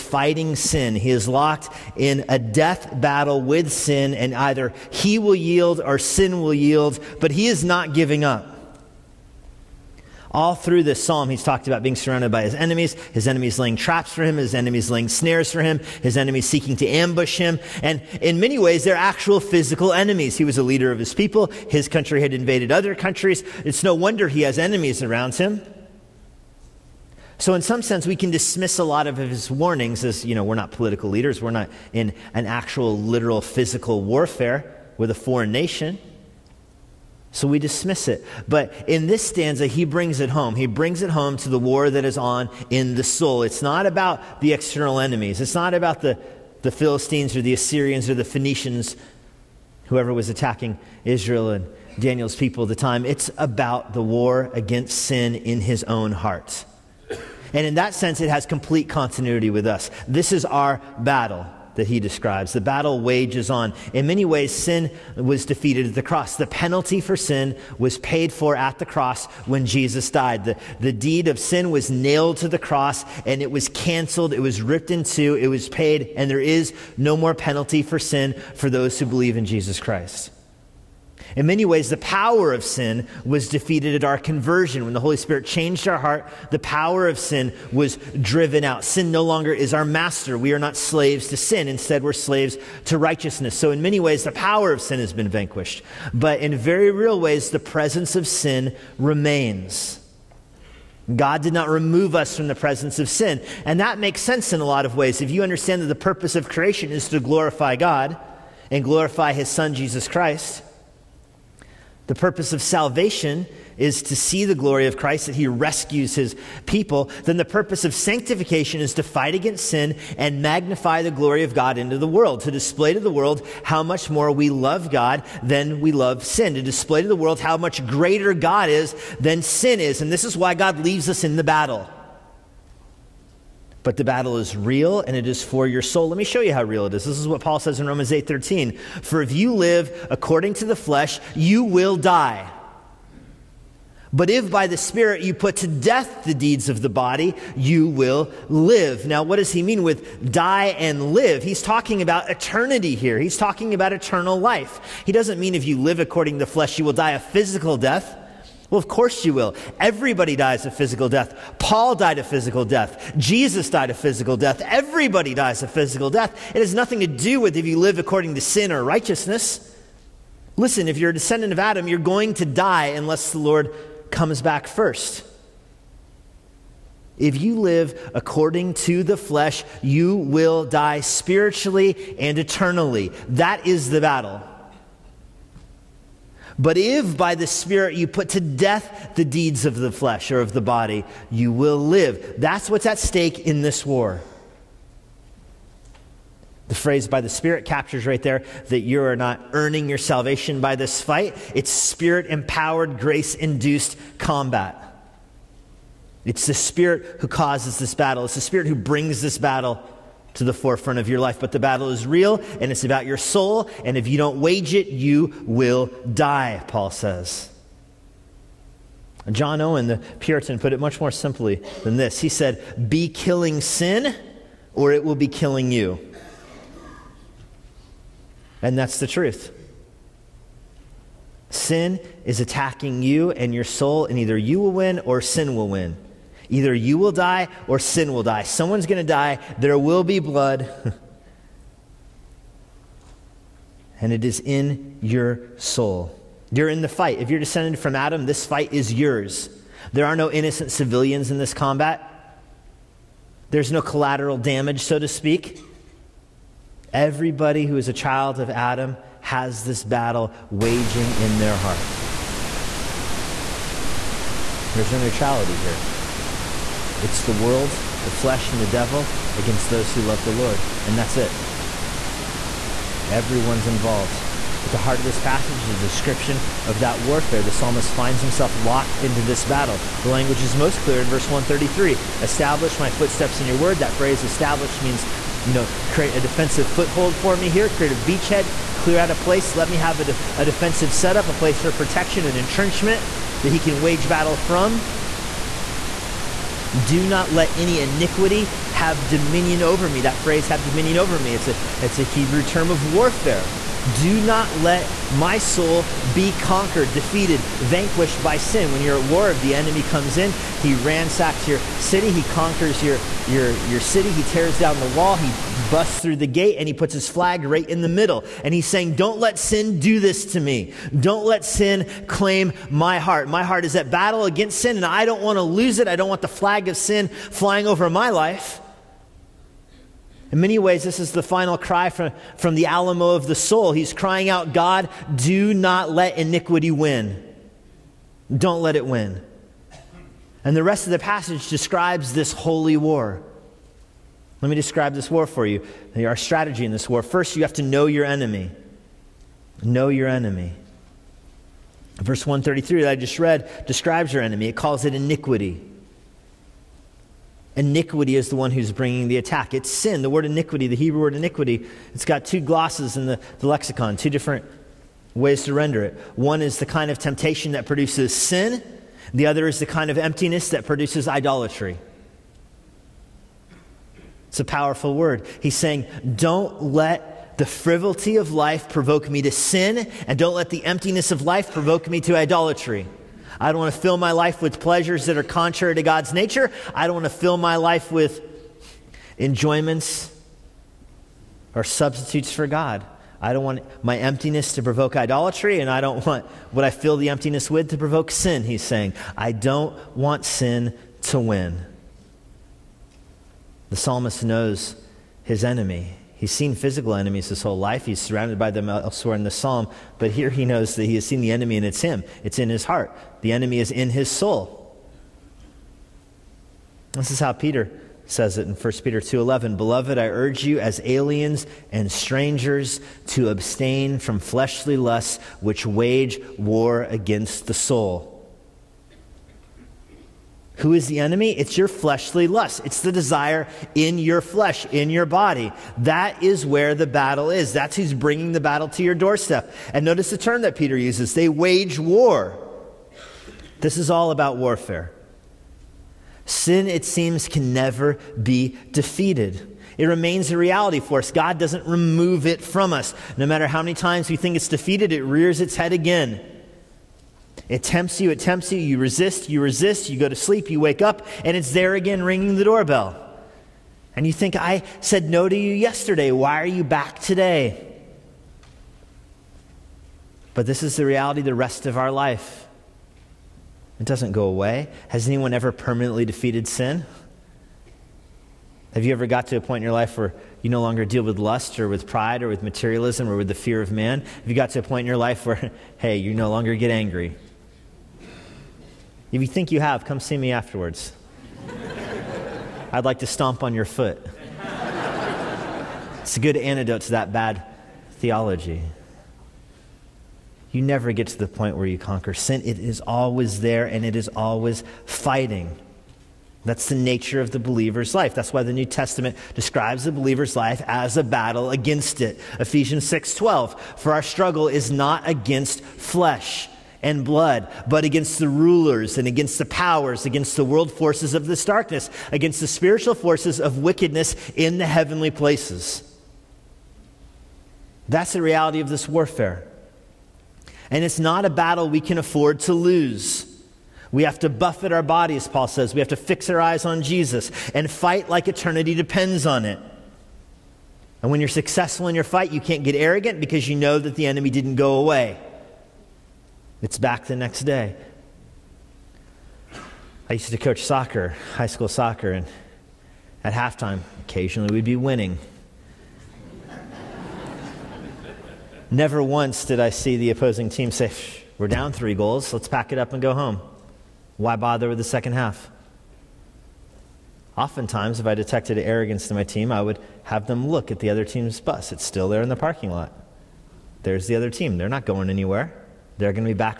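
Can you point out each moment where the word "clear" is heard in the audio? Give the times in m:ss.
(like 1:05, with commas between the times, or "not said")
4:40, 4:48.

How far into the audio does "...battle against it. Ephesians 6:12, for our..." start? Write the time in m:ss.
8:31.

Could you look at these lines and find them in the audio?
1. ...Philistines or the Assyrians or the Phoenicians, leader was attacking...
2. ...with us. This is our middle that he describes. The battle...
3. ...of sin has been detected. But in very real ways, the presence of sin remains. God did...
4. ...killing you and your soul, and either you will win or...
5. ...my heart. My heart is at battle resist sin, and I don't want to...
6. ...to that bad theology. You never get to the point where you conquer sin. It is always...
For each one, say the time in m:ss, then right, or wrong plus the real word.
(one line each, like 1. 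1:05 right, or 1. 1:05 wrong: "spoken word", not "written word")
1. 0:46 wrong: "whoever", not "leader"
2. 0:59 wrong: "battle", not "middle"
3. 1:34 wrong: "vanquished", not "detected"
4. 3:52 wrong: "attacking", not "killing"
5. 5:22 wrong: "against", not "resist"
6. 8:16 right.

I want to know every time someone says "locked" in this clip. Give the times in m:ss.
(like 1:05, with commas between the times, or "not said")
0:01, 4:38.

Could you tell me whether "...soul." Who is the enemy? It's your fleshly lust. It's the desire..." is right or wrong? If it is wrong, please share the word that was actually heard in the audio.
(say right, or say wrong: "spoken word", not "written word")
right.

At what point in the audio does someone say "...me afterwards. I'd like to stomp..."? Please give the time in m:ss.
8:10.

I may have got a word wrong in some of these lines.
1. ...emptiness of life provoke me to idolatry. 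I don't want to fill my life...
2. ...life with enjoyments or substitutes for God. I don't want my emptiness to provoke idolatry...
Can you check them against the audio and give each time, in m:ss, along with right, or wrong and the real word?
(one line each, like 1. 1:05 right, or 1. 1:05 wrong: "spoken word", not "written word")
1. 6:20 right
2. 6:27 right.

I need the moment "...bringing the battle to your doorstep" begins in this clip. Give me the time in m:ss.
7:17.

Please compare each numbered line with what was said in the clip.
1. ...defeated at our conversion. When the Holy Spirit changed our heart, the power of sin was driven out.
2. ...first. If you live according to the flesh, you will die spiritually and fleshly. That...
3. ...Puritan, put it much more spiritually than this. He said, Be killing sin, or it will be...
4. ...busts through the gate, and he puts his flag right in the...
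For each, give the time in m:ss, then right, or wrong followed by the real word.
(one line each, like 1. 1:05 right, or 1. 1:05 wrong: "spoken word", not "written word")
1. 1:23 right
2. 2:54 wrong: "eternally", not "fleshly"
3. 3:40 wrong: "simply", not "spiritually"
4. 5:15 right.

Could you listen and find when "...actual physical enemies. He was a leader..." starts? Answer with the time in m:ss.
0:18.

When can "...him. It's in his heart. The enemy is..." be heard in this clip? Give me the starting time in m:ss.
6:51.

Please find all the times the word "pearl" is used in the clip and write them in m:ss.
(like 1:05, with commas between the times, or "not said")
not said.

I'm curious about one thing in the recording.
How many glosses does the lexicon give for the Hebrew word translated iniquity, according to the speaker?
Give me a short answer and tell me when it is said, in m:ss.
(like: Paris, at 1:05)
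2, at 6:02.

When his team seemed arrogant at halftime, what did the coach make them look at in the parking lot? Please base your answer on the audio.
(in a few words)
The other team's bus.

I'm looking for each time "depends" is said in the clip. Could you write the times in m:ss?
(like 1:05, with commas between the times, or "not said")
8:58.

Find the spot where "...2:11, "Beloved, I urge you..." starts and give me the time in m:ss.
6:58.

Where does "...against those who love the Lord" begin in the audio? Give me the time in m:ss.
4:29.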